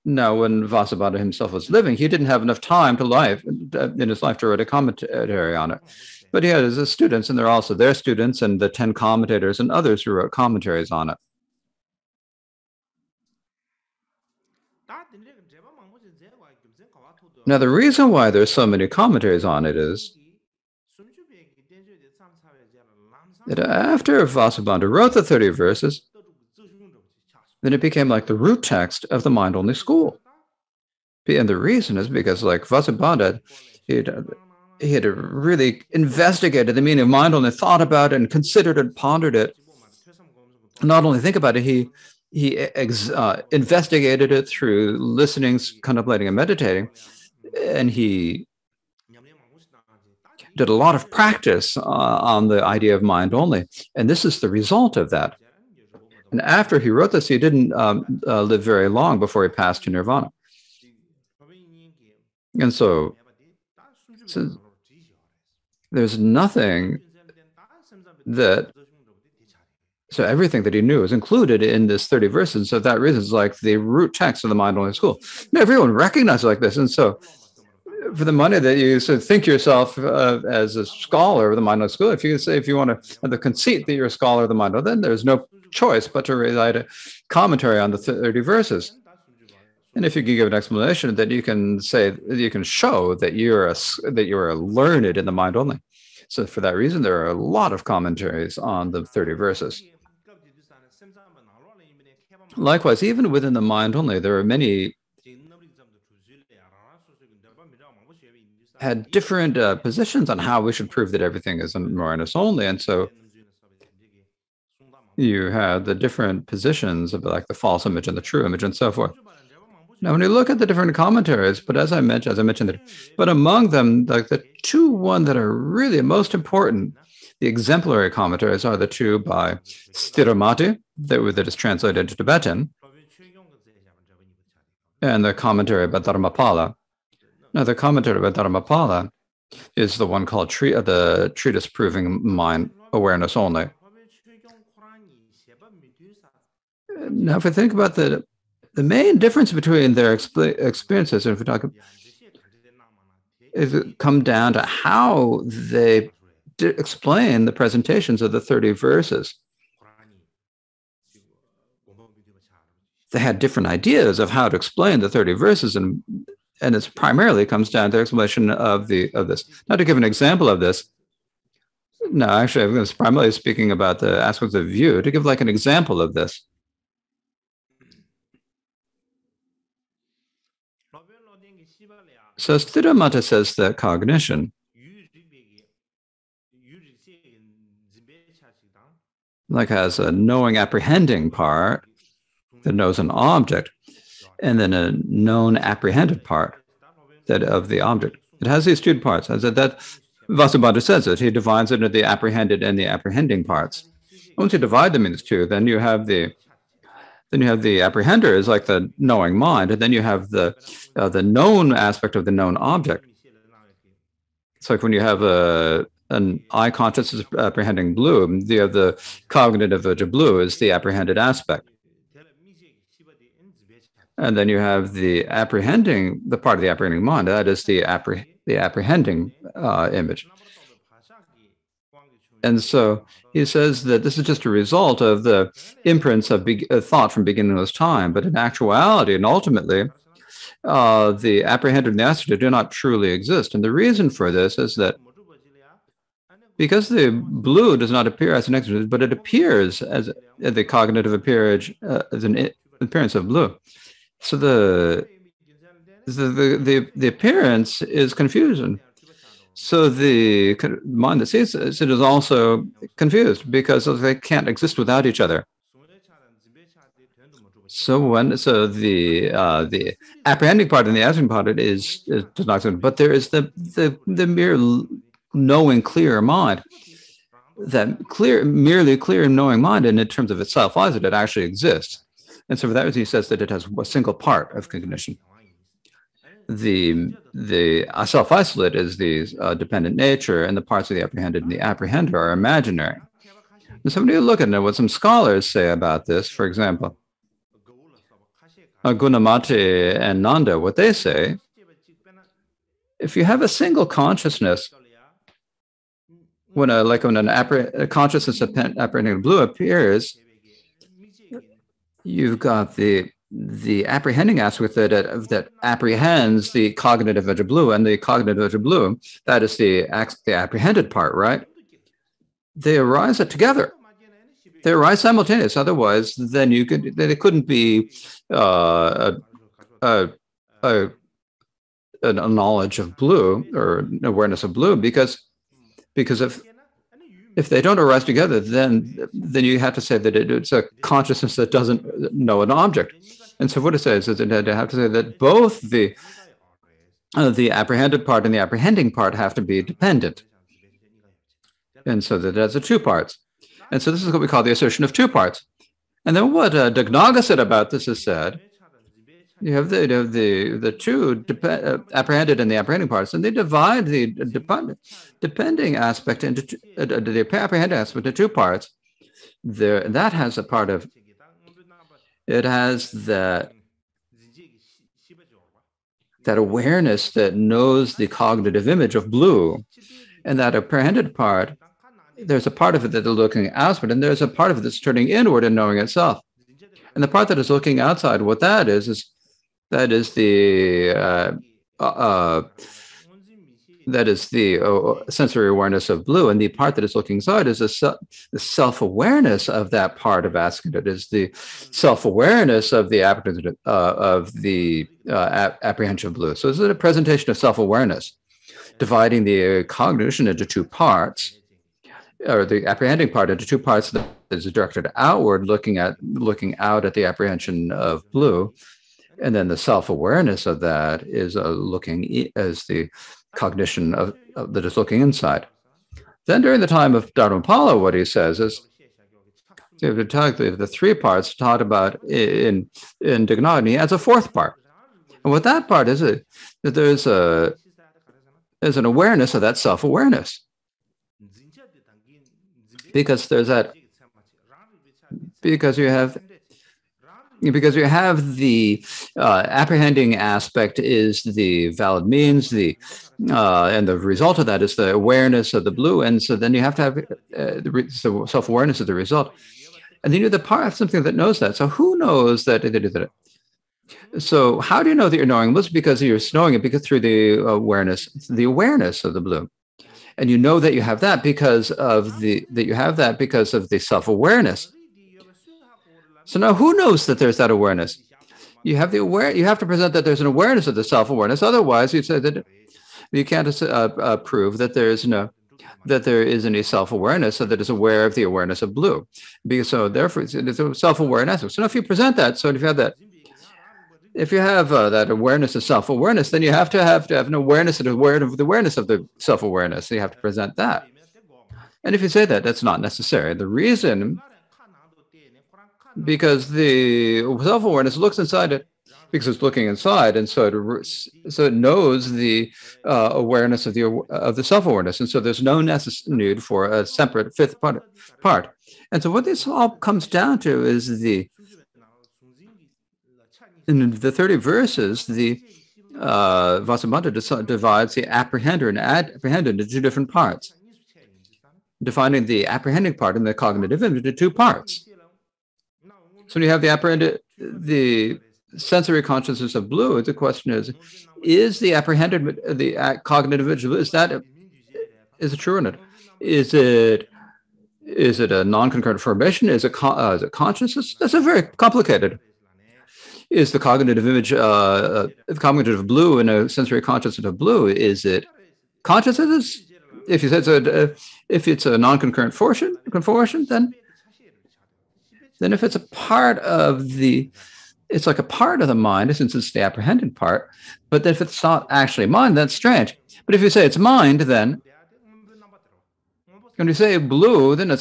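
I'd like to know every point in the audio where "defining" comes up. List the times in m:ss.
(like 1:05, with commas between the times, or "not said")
8:51.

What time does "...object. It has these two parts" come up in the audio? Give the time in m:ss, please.
3:17.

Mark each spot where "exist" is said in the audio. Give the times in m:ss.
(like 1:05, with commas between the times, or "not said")
4:03, 4:24, 4:41.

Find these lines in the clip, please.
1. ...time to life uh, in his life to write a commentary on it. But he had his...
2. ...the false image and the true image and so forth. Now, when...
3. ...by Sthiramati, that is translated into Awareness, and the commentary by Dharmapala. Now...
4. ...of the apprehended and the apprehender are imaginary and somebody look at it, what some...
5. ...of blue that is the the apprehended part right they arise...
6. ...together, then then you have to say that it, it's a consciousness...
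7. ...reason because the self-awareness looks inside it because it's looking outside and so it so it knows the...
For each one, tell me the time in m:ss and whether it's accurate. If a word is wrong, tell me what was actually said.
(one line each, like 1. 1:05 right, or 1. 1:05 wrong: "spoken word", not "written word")
1. 0:02 right
2. 1:57 right
3. 2:09 wrong: "Tibetan", not "Awareness"
4. 4:50 right
5. 5:18 right
6. 5:38 right
7. 8:23 wrong: "inside", not "outside".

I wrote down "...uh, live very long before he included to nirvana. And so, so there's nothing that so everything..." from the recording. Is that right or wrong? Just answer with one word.
wrong.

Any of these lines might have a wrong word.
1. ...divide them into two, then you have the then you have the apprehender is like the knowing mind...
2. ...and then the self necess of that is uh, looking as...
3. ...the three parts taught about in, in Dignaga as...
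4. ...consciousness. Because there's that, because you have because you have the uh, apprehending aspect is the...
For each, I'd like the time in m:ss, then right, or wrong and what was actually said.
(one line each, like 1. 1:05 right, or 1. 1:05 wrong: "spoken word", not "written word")
1. 3:24 right
2. 6:59 wrong: "awareness", not "necess"
3. 7:09 right
4. 7:19 wrong: "awareness", not "consciousness".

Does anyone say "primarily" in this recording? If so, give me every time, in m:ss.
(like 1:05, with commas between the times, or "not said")
2:46, 2:52.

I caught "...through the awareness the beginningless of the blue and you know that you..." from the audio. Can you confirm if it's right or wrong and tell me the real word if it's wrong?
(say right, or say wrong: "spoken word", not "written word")
wrong: "awareness", not "beginningless".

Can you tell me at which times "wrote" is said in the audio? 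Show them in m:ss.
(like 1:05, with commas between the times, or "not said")
0:10, 0:24, 0:56.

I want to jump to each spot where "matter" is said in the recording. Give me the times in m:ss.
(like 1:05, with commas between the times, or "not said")
not said.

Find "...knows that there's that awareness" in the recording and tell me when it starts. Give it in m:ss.
7:56.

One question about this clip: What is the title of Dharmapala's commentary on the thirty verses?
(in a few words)
Treatise Proving Mind Awareness Only.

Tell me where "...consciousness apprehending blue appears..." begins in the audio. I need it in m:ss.
5:07.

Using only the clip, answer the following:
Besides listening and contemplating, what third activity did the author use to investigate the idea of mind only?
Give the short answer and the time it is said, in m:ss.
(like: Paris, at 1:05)
Meditating, at 0:46.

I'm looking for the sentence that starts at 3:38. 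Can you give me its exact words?
The, the cognitive of of blue is the apprehended aspect.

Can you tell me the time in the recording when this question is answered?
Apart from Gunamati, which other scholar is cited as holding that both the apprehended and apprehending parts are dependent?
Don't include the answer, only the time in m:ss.
5:00.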